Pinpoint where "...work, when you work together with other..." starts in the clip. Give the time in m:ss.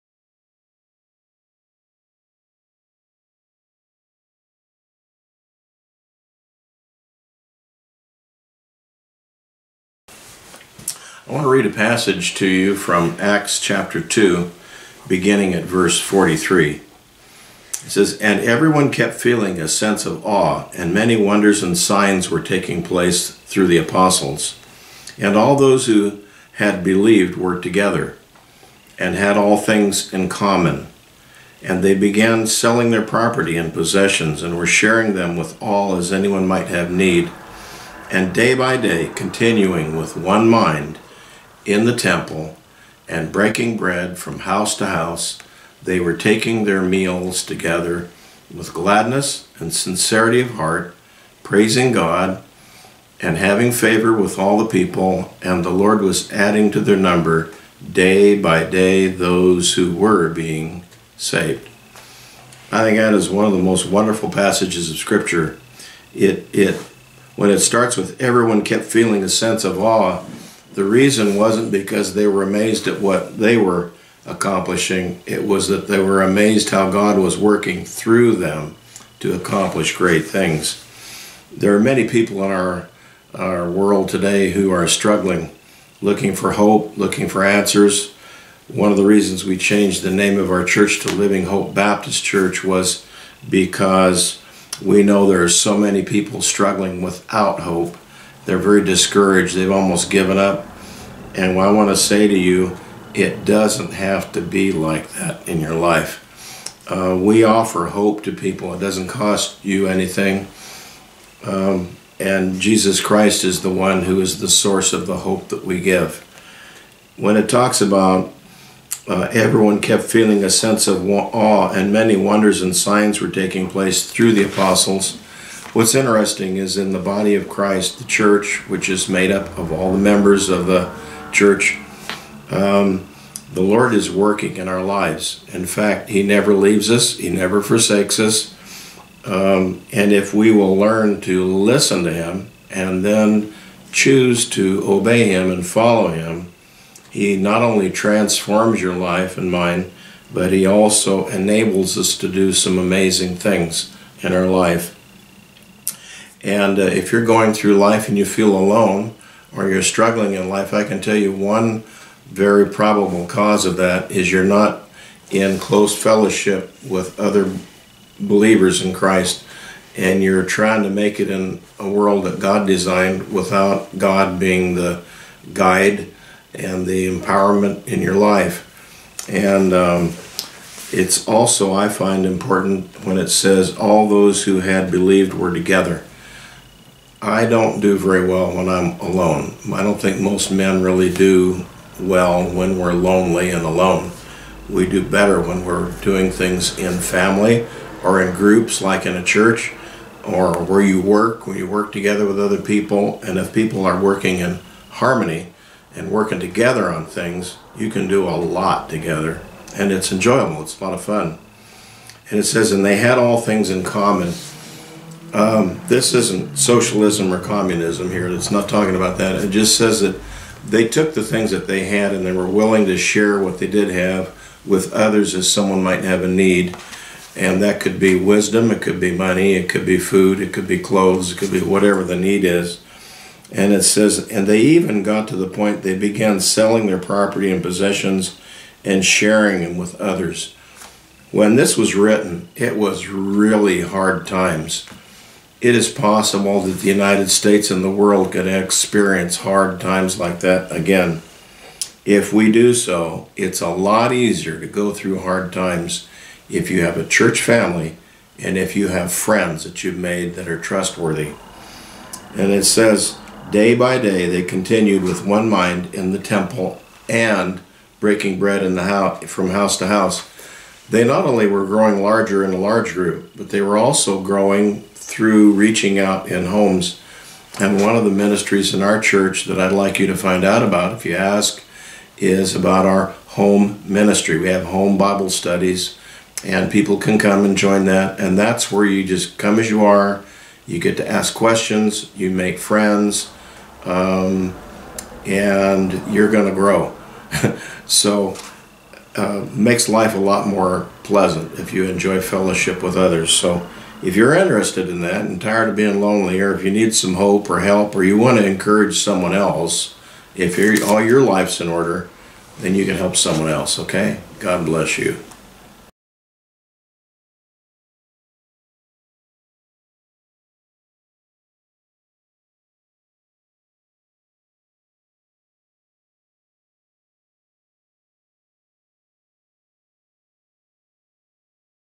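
3:20.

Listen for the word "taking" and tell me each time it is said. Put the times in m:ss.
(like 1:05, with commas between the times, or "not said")
0:22, 0:46, 2:03.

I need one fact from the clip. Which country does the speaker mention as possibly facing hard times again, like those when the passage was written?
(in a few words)
United States.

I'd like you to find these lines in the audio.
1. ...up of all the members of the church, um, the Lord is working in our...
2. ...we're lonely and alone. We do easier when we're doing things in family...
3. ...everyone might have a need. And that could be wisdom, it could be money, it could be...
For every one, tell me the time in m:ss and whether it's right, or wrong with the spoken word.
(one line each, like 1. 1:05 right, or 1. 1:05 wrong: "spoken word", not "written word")
1. 2:09 right
2. 3:12 wrong: "better", not "easier"
3. 3:45 wrong: "someone", not "everyone".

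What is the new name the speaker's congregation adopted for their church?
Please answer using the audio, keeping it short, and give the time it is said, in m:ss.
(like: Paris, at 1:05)
Living Hope Baptist Church, at 1:31.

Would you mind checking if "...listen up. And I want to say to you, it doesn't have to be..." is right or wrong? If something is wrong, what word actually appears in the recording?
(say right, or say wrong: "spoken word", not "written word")
wrong: "given", not "listen".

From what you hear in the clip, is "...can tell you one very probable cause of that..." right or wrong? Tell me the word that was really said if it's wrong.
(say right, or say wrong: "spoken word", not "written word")
right.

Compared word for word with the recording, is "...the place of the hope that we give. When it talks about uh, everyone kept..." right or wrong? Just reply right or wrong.
wrong.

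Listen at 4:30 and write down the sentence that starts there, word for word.
They not only were growing larger in a large group, but they were also growing through reaching out in homes.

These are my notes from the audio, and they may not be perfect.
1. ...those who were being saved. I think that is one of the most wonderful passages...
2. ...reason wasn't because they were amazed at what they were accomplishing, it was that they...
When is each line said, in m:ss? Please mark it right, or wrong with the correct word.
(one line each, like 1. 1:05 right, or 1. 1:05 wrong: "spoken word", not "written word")
1. 0:59 right
2. 1:10 right.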